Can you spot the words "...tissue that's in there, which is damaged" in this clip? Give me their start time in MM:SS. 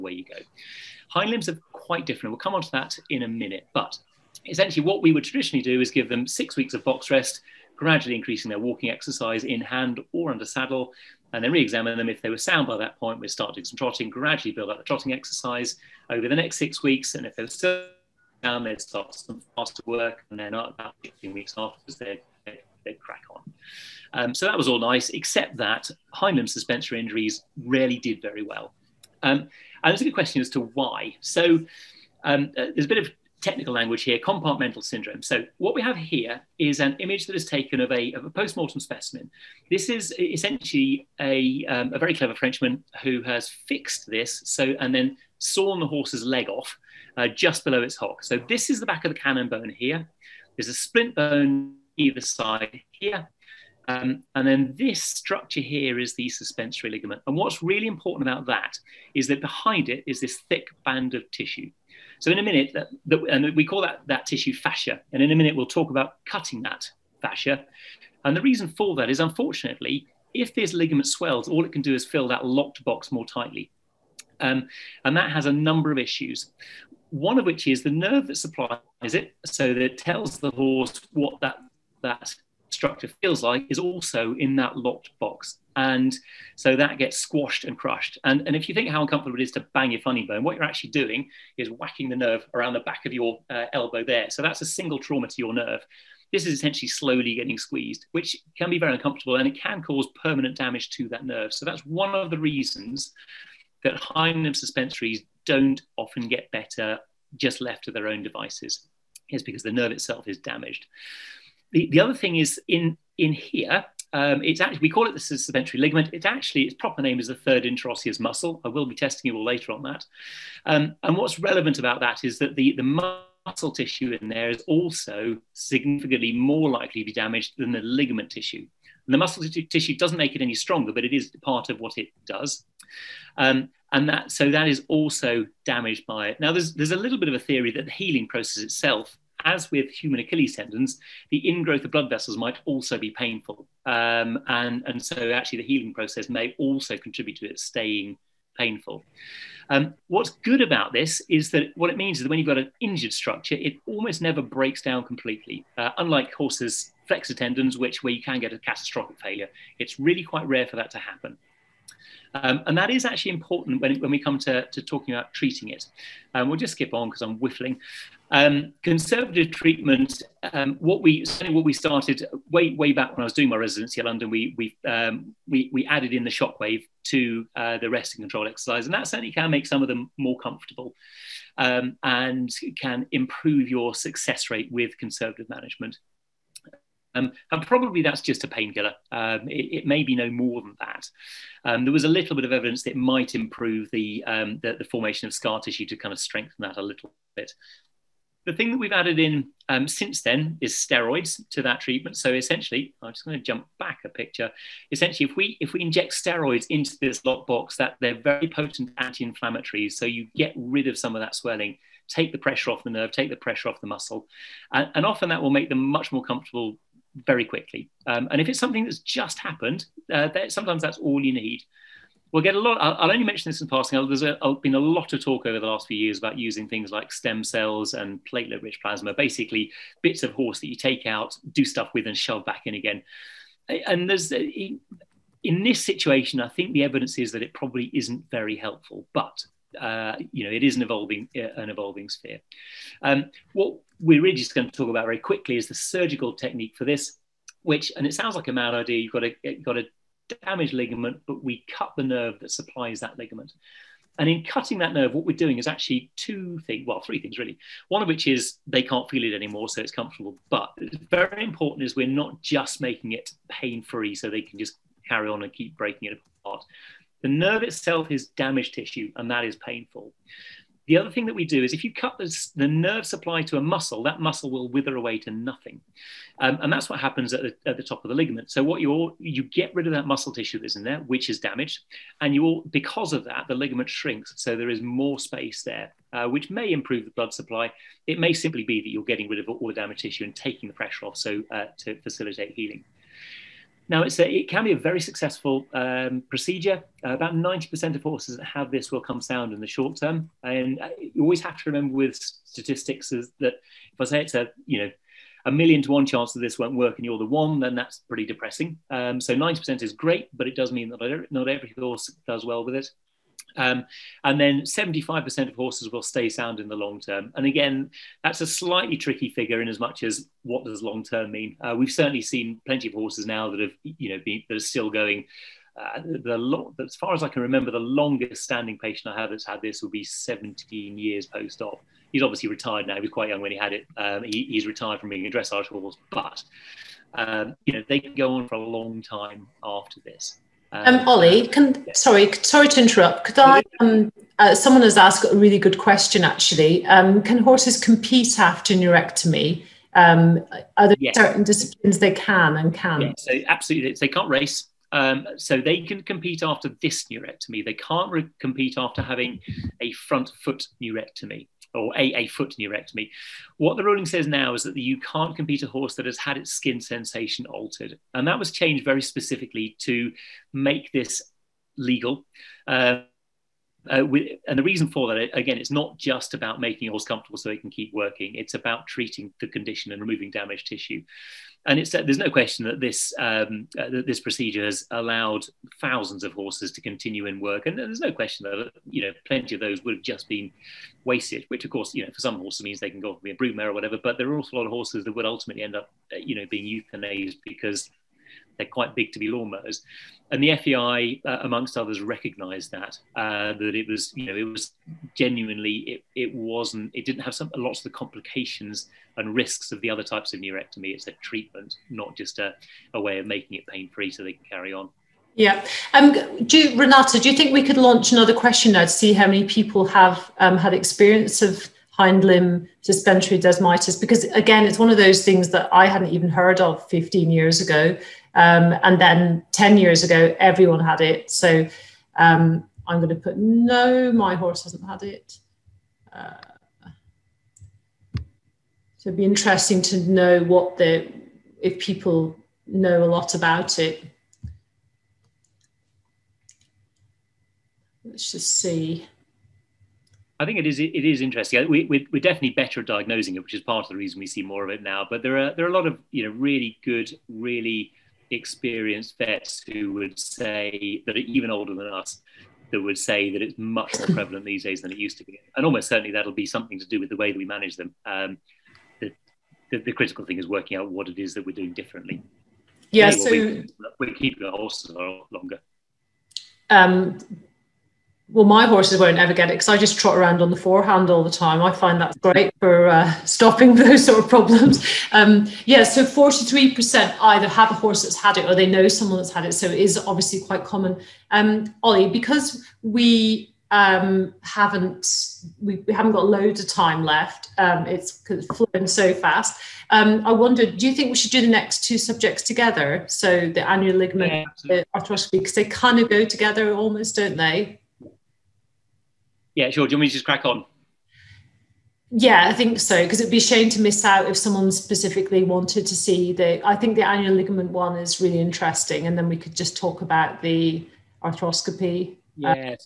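04:40.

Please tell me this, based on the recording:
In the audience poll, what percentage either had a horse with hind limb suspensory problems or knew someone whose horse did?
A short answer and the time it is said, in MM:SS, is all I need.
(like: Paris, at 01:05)
43%, at 08:06.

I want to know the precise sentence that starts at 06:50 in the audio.
It's a treatment, not just a, a way of making it pain free so they can carry on.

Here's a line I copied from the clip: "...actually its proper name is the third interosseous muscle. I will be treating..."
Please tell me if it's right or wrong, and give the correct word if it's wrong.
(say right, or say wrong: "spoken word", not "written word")
wrong: "testing", not "treating".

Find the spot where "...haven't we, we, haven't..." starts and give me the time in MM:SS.
08:14.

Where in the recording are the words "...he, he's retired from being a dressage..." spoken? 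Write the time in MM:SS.
05:34.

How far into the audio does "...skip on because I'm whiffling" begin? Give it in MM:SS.
02:46.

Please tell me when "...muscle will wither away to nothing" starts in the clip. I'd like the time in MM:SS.
04:34.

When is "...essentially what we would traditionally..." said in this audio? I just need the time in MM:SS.
00:04.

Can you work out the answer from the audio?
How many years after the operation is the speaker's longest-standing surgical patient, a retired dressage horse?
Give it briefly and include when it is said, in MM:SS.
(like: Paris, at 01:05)
17, at 05:30.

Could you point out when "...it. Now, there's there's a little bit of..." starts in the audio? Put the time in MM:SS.
02:16.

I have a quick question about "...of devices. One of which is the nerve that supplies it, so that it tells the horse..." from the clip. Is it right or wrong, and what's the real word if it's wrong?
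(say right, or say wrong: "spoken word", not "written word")
wrong: "issues", not "devices".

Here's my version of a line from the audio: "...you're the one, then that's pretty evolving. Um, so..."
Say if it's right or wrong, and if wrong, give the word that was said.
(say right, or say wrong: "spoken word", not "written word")
wrong: "depressing", not "evolving".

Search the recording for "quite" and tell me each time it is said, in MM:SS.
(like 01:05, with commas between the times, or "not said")
00:01, 02:40, 05:33, 06:38, 08:10.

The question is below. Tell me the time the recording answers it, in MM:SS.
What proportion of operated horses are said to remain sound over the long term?
05:14.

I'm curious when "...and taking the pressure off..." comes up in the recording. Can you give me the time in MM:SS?
04:50.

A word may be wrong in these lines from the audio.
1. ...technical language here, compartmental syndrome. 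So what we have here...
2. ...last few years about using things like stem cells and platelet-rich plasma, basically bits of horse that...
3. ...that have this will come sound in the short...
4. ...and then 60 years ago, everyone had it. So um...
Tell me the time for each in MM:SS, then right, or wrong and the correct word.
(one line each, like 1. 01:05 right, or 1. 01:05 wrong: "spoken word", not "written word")
1. 00:33 right
2. 03:45 right
3. 04:58 right
4. 07:08 wrong: "10", not "60".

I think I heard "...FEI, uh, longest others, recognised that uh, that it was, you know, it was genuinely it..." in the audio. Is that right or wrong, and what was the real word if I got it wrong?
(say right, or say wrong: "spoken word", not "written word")
wrong: "amongst", not "longest".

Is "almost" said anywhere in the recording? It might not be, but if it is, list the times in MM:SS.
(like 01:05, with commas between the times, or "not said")
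02:33, 07:45, 08:26.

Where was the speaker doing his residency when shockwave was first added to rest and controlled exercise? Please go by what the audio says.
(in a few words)
London.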